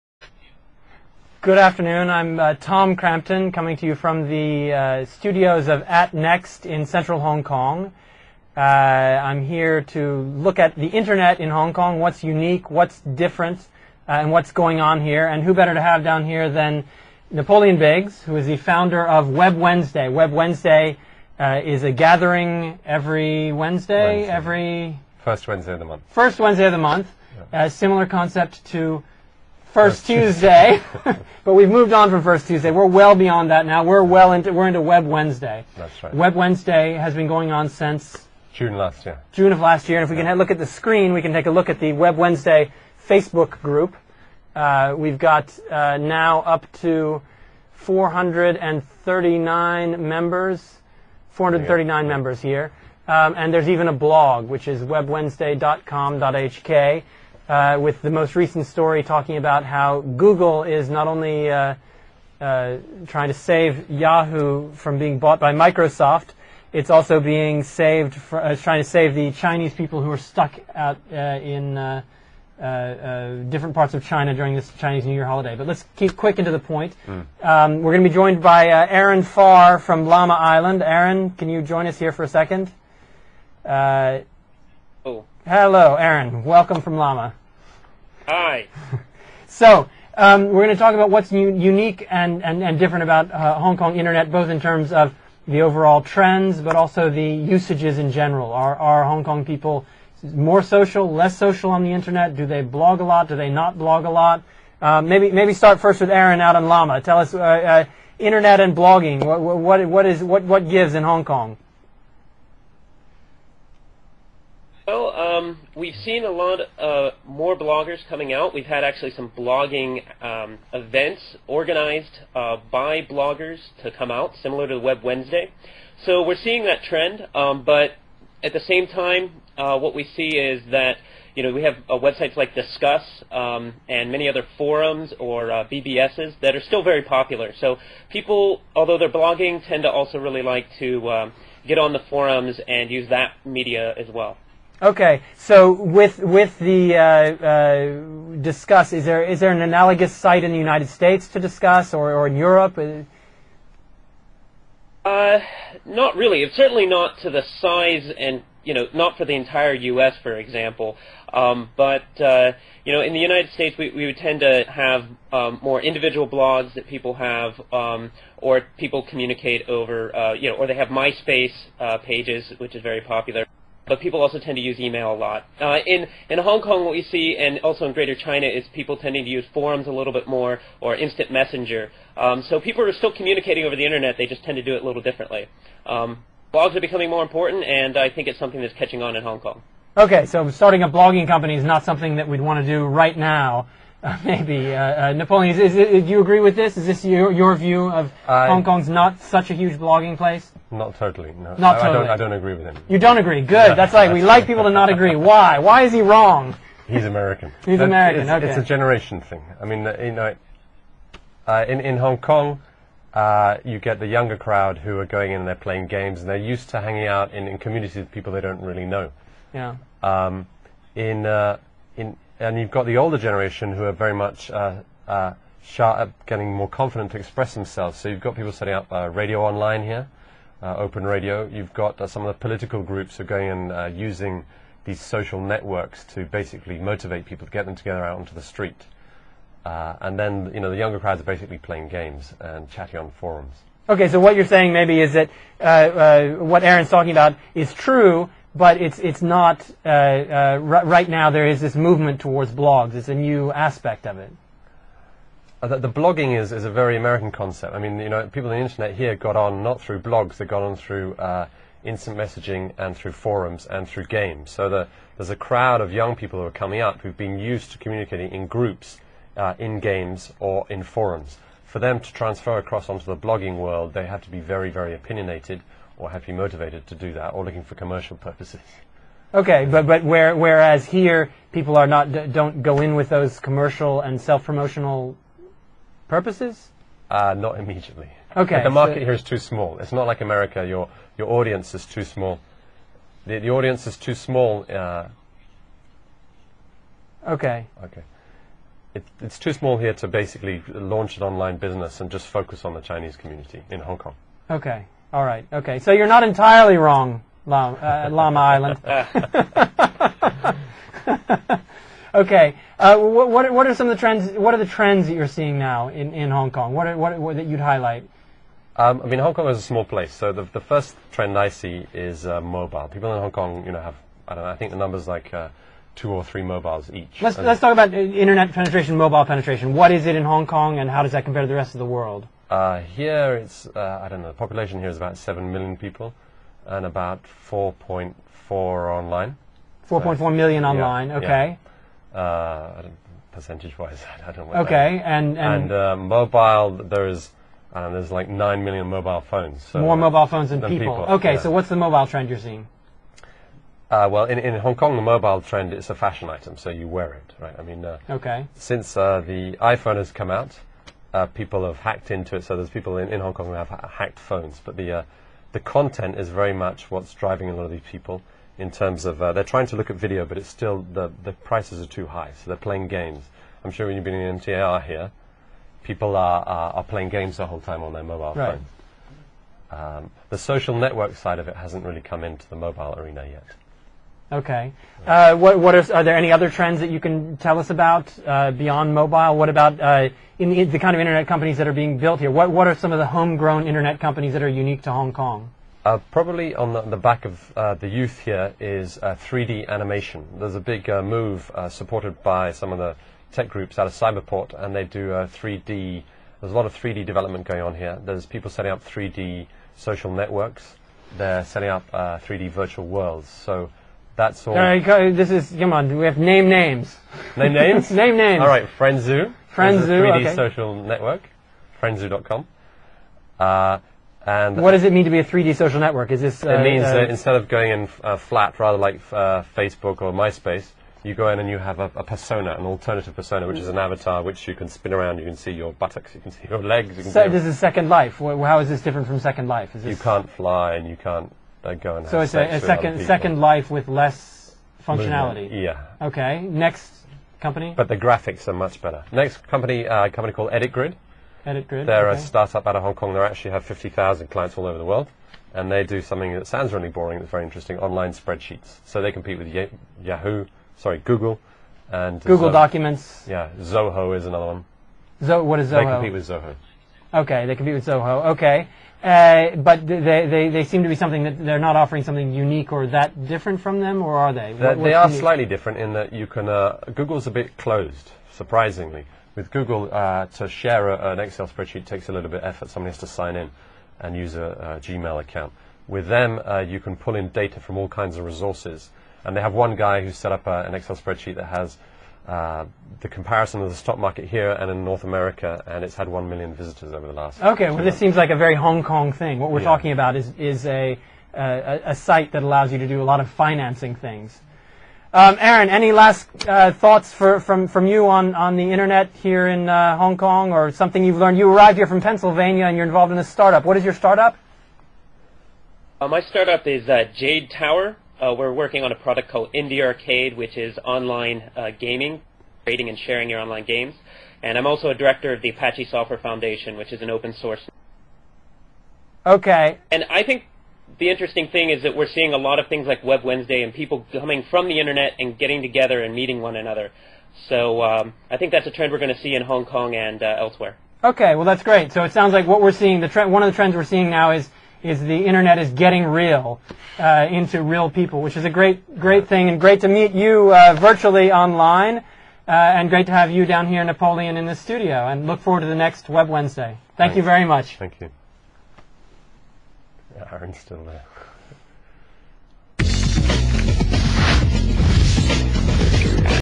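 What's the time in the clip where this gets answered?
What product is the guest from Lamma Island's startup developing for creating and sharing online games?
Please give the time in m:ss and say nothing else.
8:39.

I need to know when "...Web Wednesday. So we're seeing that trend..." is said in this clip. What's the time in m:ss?
2:04.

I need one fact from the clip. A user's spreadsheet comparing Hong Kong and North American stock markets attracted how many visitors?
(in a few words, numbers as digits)
1 million.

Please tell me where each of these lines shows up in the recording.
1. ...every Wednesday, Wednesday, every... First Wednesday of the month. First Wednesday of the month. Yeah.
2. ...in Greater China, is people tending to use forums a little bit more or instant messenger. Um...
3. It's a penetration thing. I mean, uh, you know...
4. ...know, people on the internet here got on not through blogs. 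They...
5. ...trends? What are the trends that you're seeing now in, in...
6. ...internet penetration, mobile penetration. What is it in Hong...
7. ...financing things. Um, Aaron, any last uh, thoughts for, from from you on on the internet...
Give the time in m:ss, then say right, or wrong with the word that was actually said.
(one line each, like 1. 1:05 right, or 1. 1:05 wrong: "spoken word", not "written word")
1. 0:22 right
2. 2:57 right
3. 3:28 wrong: "generation", not "penetration"
4. 4:18 right
5. 5:13 right
6. 5:27 right
7. 8:23 right.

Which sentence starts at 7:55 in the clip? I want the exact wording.
slightly different in that you can.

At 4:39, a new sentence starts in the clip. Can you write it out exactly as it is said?
Okay, but but where, whereas here people are not don't go in with those commercial and self promotional purposes.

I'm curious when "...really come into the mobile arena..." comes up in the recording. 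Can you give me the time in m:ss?
6:21.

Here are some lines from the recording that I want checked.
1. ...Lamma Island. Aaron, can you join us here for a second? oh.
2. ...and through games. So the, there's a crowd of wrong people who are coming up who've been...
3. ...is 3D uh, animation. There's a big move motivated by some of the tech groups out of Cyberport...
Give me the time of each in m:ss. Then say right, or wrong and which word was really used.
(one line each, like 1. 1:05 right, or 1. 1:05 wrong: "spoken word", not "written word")
1. 1:20 right
2. 4:23 wrong: "young", not "wrong"
3. 6:38 wrong: "supported", not "motivated".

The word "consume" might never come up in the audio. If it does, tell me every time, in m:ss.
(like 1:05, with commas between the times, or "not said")
not said.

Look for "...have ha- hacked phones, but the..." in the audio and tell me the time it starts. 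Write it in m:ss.
6:03.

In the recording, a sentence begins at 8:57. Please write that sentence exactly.
So um, I think that's a trend we're going to see in Hong Kong and uh, elsewhere.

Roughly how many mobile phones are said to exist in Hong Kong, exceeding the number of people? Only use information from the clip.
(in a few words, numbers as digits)
9 million.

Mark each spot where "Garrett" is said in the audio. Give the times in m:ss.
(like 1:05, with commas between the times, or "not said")
not said.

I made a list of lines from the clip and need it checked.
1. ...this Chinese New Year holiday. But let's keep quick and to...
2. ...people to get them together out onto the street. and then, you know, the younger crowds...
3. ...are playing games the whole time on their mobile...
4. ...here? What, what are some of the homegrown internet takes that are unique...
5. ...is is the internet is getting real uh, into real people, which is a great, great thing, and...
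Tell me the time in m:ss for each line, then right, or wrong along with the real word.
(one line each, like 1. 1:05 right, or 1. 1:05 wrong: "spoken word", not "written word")
1. 1:14 right
2. 3:57 right
3. 6:16 right
4. 6:32 wrong: "companies", not "takes"
5. 9:04 right.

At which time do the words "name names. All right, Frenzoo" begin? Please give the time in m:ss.
6:57.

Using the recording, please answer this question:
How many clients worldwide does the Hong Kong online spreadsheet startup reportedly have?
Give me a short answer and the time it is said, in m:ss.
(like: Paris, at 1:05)
50,000, at 7:33.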